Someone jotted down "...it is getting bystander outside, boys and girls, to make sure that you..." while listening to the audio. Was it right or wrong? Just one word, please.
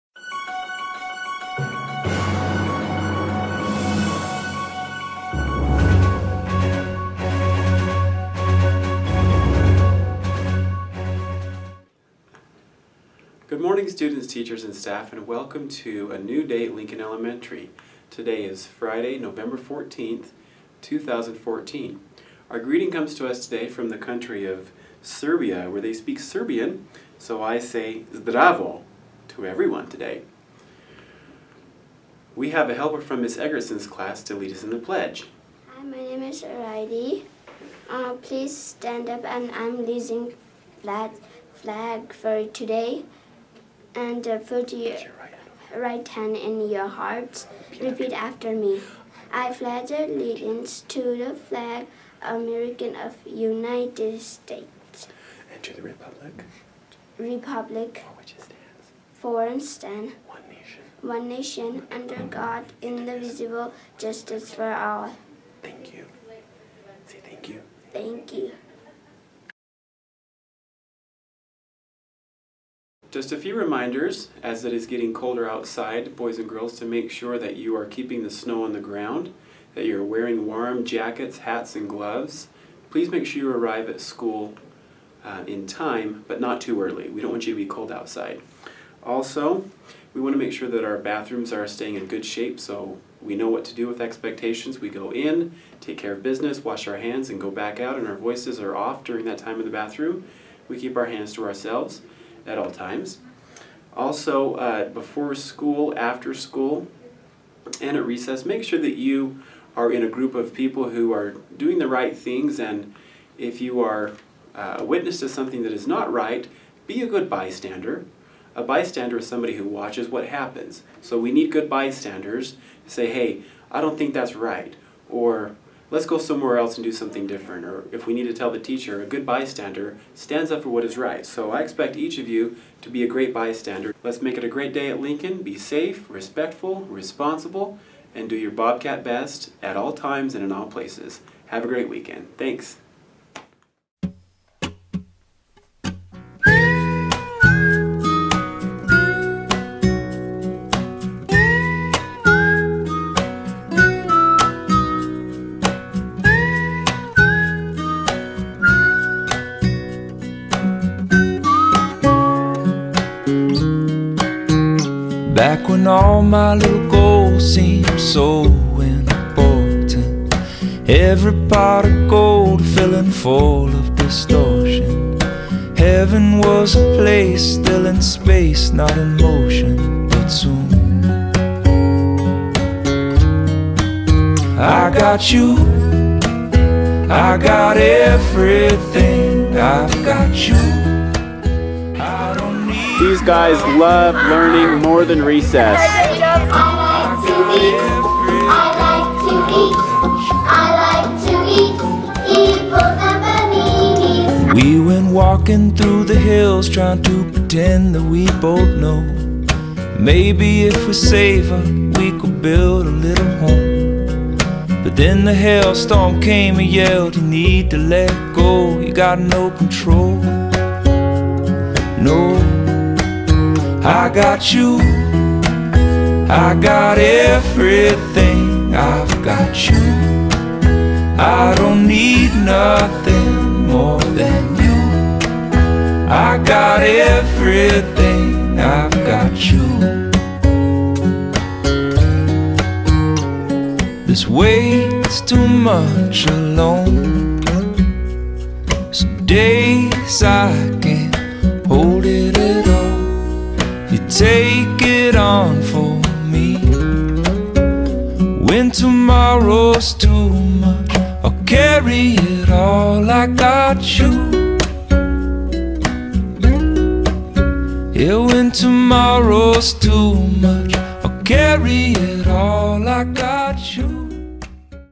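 wrong.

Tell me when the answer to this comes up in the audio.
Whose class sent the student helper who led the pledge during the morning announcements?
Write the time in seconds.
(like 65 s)
33 s.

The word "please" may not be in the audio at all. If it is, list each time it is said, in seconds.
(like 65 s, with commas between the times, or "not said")
38 s, 82 s.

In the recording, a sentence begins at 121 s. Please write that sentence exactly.
So we need good bystanders to say, hey, I don't think that's right.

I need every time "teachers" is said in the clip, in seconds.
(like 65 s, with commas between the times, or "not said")
14 s, 128 s.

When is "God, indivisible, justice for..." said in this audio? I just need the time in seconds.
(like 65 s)
62 s.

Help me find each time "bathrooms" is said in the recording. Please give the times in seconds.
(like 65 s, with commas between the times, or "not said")
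90 s, 99 s.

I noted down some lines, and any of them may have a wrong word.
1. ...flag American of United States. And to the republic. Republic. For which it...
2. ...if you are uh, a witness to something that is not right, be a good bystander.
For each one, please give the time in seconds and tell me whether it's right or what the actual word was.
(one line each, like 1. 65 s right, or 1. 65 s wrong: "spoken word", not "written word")
1. 51 s right
2. 113 s right.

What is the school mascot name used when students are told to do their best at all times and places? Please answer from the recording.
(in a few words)
Bobcat.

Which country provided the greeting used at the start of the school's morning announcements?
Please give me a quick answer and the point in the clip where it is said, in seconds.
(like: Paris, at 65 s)
Serbia, at 25 s.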